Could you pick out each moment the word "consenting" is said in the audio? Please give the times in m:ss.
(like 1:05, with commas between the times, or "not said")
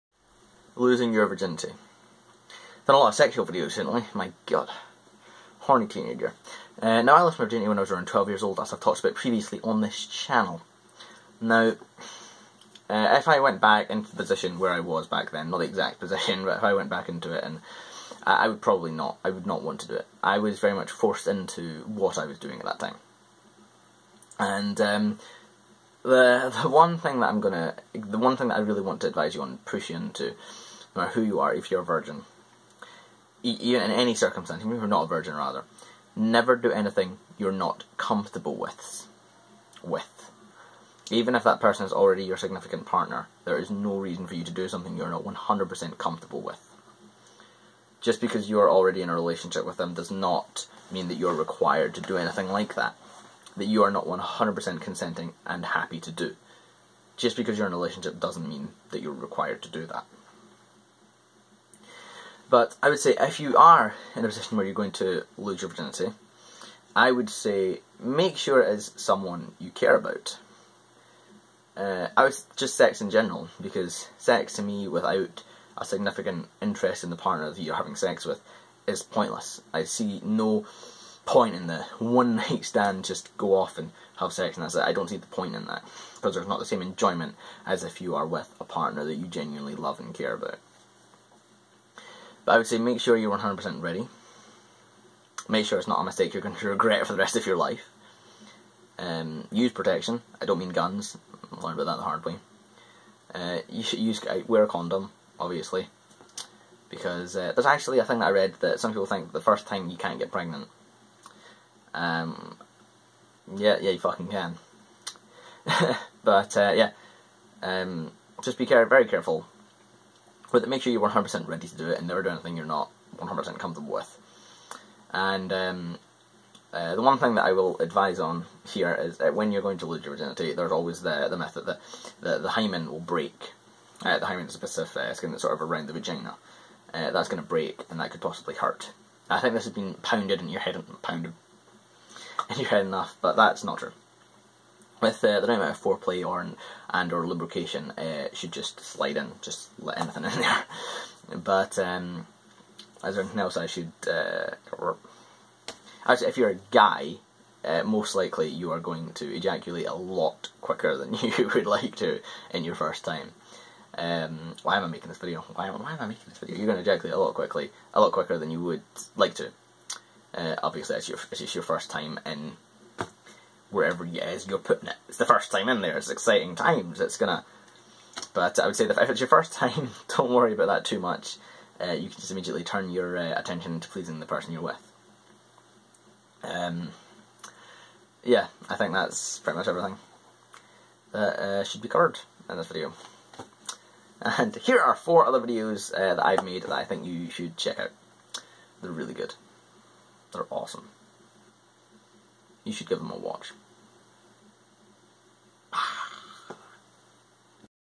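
0:54.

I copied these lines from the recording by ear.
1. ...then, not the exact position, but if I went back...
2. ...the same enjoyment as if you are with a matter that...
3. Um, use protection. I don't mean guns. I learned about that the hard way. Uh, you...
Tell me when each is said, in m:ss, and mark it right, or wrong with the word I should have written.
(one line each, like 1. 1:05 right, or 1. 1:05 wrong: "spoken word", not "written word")
1. 0:15 right
2. 1:26 wrong: "partner", not "matter"
3. 1:38 right.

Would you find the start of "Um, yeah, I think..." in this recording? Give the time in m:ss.
3:06.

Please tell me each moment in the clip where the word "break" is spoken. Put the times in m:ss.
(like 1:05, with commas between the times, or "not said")
2:13, 2:17.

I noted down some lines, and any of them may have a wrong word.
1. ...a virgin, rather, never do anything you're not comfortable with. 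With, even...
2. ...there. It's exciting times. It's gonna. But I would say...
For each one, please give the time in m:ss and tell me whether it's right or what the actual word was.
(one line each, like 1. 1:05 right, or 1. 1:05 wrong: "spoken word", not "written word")
1. 0:35 right
2. 2:55 right.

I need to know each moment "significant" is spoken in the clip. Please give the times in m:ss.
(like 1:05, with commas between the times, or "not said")
0:42, 1:15.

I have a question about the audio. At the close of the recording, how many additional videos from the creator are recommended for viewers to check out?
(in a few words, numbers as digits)
4.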